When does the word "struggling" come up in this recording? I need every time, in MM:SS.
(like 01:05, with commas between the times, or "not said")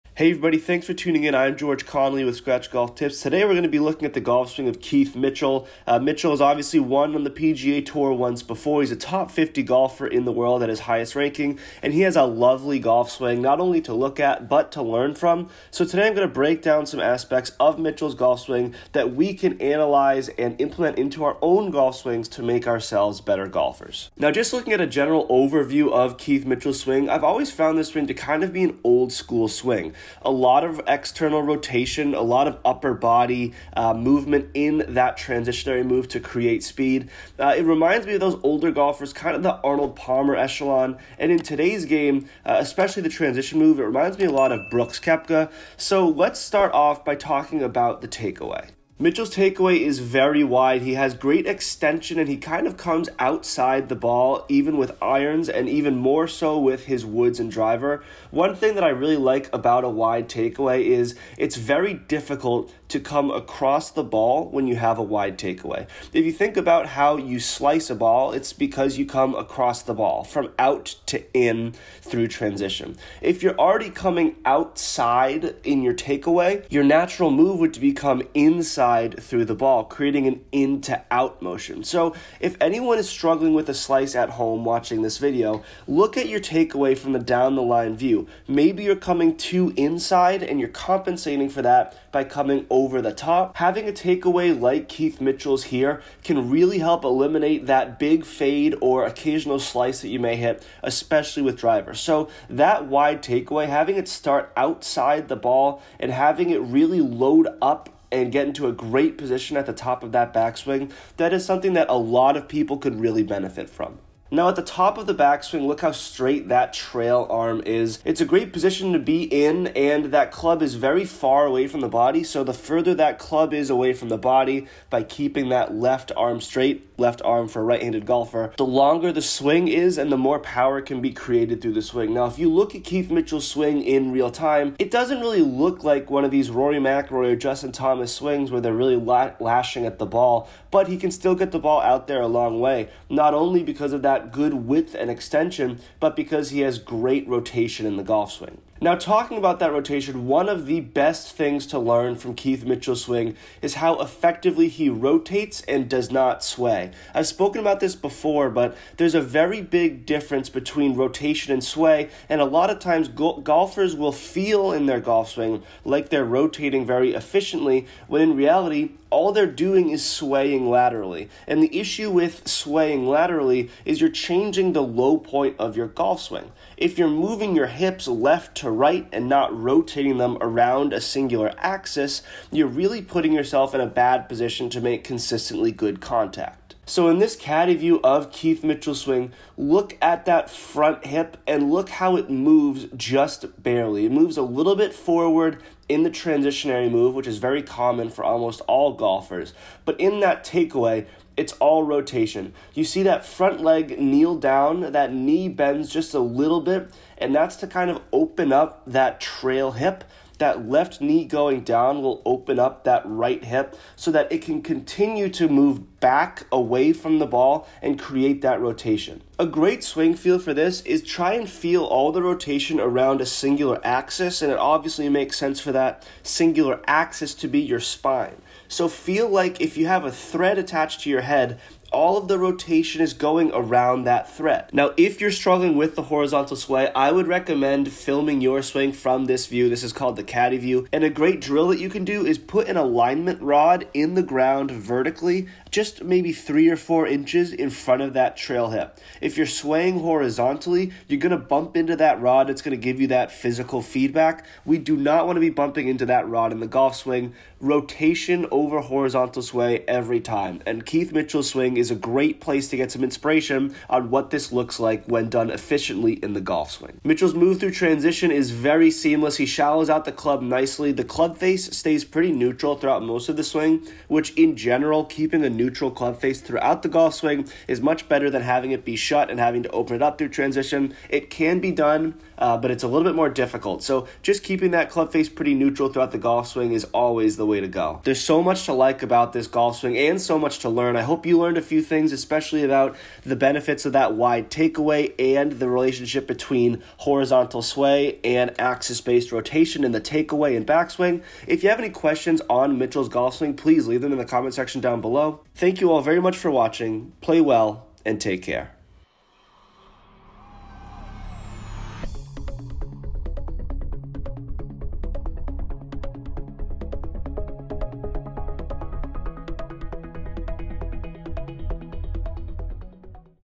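01:23, 03:55.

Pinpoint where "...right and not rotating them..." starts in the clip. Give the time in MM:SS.
02:58.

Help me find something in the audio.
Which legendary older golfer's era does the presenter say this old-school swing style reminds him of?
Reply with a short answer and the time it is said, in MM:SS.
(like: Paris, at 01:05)
Arnold Palmer, at 00:39.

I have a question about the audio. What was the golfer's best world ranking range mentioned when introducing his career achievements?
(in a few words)
Top 50.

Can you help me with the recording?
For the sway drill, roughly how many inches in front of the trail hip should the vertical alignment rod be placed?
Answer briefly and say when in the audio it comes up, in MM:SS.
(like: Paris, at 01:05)
3 or 4 inches, at 04:06.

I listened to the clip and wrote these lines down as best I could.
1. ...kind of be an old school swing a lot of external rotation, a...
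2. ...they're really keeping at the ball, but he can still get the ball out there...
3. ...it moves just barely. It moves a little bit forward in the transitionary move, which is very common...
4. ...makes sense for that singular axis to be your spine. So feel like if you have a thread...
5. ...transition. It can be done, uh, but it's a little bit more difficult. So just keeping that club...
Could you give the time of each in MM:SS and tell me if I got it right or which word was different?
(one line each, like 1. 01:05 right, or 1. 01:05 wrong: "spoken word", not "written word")
1. 00:28 right
2. 02:18 wrong: "lashing", not "keeping"
3. 03:12 right
4. 03:45 right
5. 04:40 right.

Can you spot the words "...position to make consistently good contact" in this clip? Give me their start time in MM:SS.
03:04.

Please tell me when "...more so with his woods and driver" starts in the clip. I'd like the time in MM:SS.
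00:55.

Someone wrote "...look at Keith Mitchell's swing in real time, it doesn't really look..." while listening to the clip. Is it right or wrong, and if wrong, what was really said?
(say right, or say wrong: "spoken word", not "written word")
right.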